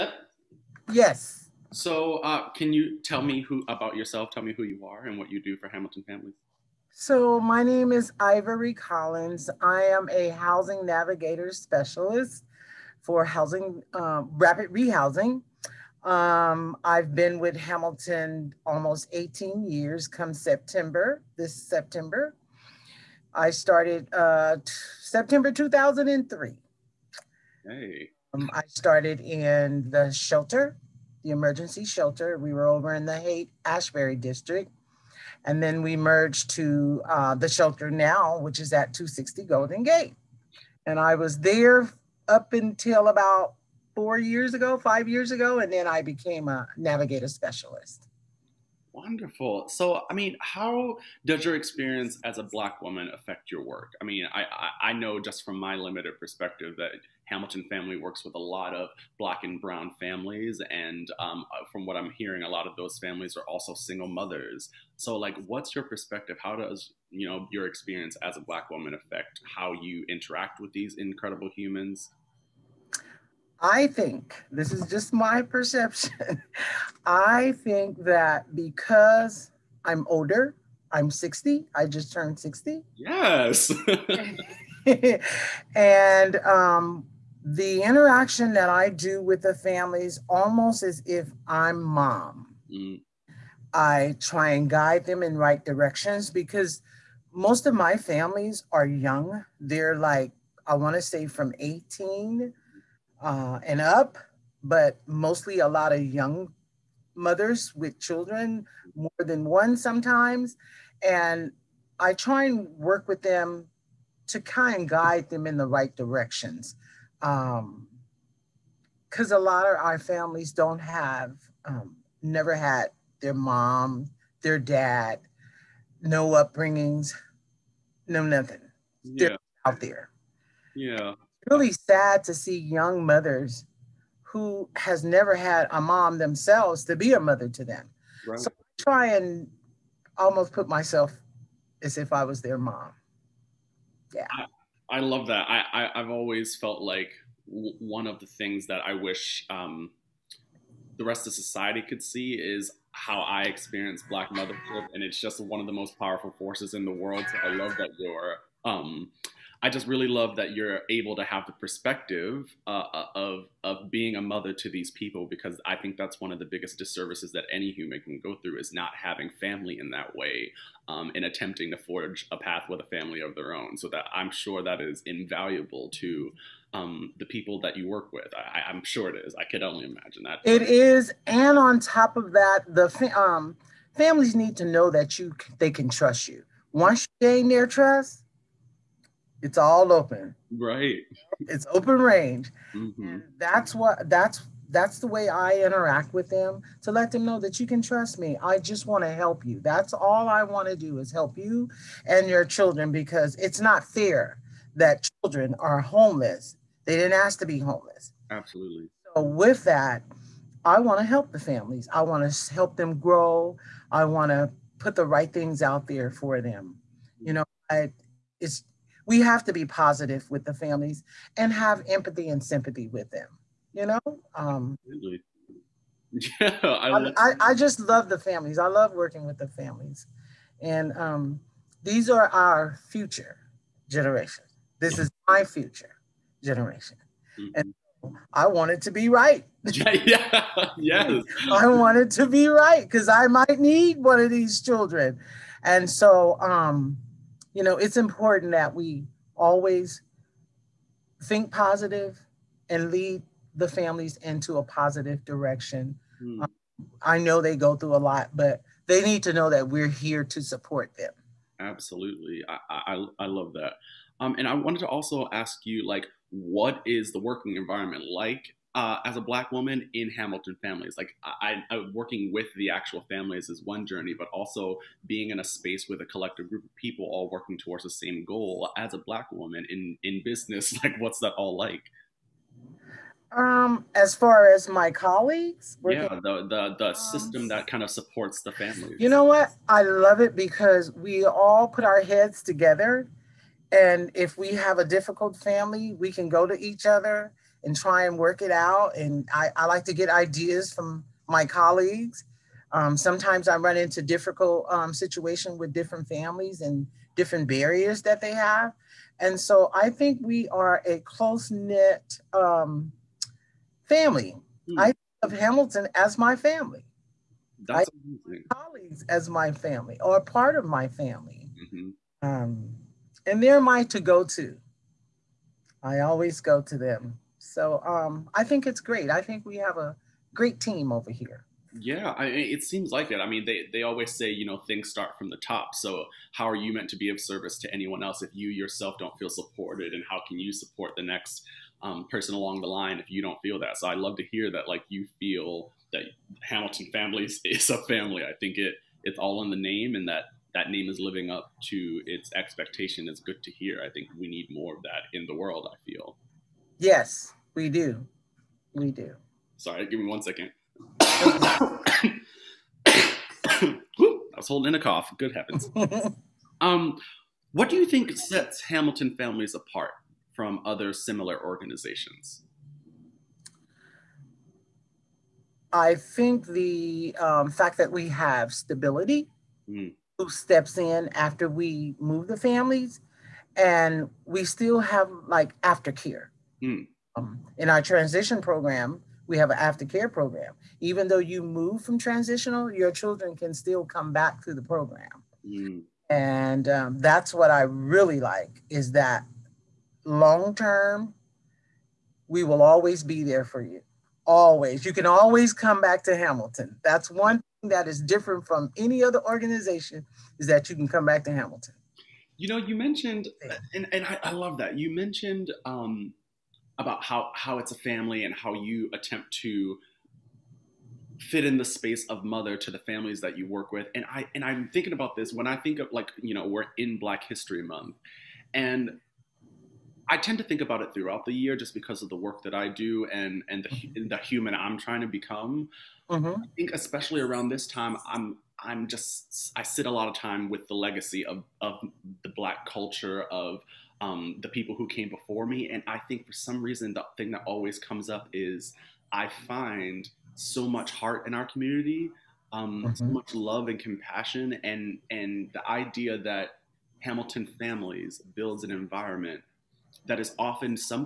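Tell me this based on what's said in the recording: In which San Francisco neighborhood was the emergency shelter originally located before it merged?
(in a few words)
Haight Ashbury.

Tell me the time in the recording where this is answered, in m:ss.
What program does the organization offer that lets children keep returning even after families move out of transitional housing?
6:29.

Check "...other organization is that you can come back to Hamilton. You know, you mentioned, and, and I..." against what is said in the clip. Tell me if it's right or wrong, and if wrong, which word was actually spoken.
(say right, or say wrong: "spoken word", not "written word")
right.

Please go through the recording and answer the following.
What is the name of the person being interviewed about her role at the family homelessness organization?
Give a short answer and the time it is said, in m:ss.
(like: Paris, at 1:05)
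Ivory Collins, at 0:08.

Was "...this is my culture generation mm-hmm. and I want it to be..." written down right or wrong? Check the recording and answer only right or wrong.
wrong.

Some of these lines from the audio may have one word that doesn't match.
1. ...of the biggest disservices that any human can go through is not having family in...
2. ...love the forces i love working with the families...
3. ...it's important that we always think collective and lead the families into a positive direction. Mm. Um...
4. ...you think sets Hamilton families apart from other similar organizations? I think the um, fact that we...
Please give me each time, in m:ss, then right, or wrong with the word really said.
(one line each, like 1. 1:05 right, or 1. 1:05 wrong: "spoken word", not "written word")
1. 2:46 right
2. 3:47 wrong: "families", not "forces"
3. 4:07 wrong: "positive", not "collective"
4. 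6:07 right.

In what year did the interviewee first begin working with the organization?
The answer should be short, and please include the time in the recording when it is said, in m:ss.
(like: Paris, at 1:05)
2003, at 0:25.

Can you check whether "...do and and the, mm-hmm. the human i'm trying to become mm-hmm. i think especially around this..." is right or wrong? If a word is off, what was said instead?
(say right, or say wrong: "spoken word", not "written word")
right.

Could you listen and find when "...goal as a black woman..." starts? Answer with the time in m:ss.
4:38.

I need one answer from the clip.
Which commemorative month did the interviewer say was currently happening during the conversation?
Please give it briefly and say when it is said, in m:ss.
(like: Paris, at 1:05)
Black History Month, at 7:06.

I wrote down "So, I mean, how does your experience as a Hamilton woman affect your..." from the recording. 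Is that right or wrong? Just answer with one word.
wrong.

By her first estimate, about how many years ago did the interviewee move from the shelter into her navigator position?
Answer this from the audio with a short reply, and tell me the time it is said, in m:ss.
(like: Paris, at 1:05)
4, at 0:43.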